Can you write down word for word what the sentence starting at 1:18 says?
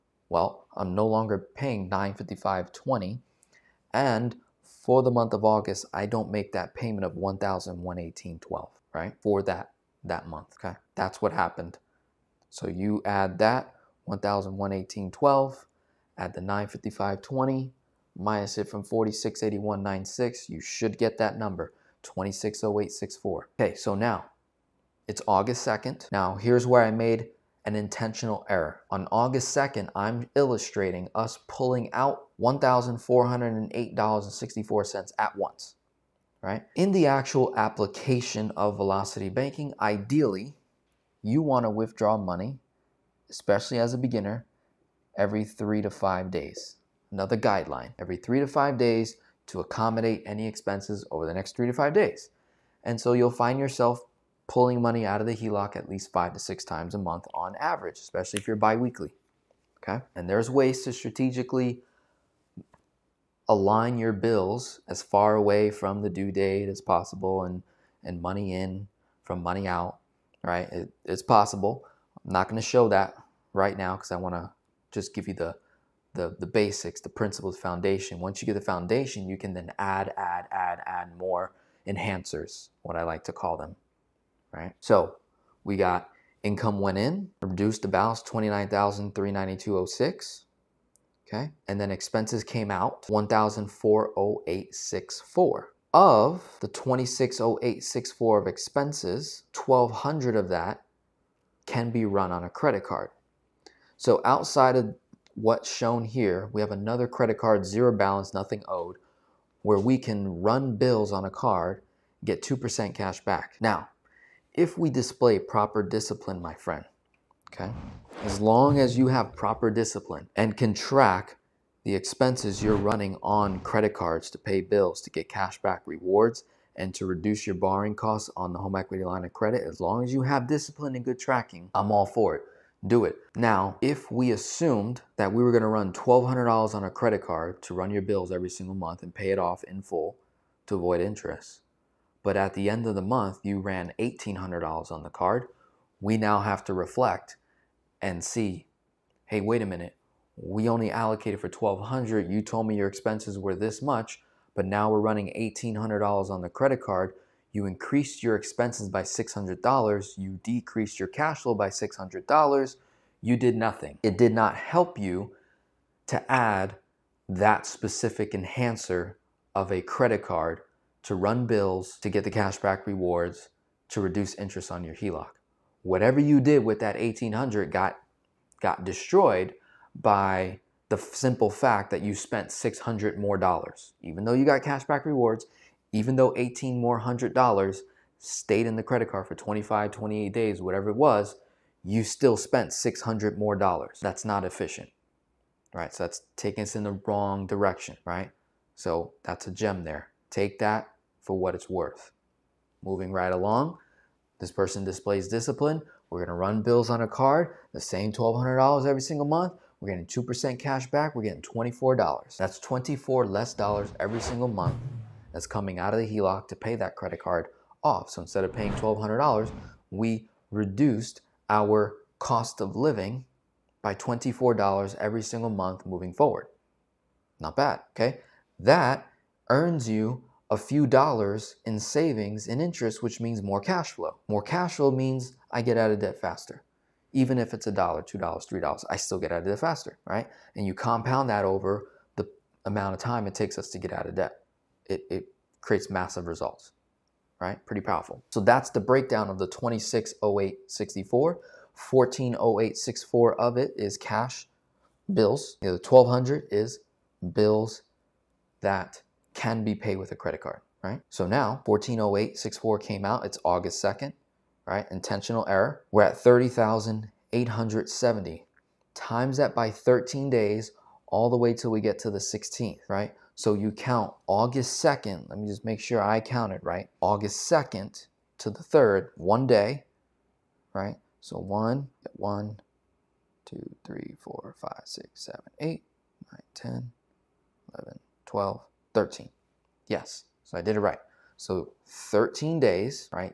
Once you get the foundation, you can then add, add, add, add more enhancers, what I like to call them right?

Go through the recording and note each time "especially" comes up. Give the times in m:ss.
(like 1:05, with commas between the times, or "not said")
0:43, 0:57.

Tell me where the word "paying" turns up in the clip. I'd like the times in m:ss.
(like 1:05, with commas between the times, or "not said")
0:01, 3:38.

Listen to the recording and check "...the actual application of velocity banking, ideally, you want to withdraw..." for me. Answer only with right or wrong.
right.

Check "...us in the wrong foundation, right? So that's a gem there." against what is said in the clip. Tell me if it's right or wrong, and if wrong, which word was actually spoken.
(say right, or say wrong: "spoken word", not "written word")
wrong: "direction", not "foundation".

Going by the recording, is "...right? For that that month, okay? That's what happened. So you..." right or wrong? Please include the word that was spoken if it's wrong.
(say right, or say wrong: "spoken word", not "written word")
right.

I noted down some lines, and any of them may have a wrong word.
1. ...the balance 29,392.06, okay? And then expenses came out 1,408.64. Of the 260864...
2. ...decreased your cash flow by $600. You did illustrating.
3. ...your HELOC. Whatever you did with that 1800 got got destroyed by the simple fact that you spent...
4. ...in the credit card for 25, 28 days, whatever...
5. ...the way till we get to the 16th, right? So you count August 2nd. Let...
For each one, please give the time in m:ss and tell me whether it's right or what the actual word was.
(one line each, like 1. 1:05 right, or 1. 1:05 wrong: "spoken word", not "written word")
1. 1:27 right
2. 2:40 wrong: "nothing", not "illustrating"
3. 2:54 right
4. 3:08 right
5. 4:31 right.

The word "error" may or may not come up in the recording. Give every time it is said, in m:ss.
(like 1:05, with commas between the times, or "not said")
0:28, 4:25.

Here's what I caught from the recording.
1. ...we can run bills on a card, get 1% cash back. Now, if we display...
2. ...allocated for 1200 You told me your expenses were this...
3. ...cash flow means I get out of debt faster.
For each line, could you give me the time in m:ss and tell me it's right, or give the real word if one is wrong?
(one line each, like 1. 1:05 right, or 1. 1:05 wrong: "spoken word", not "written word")
1. 1:49 wrong: "2", not "1"
2. 2:30 right
3. 3:54 right.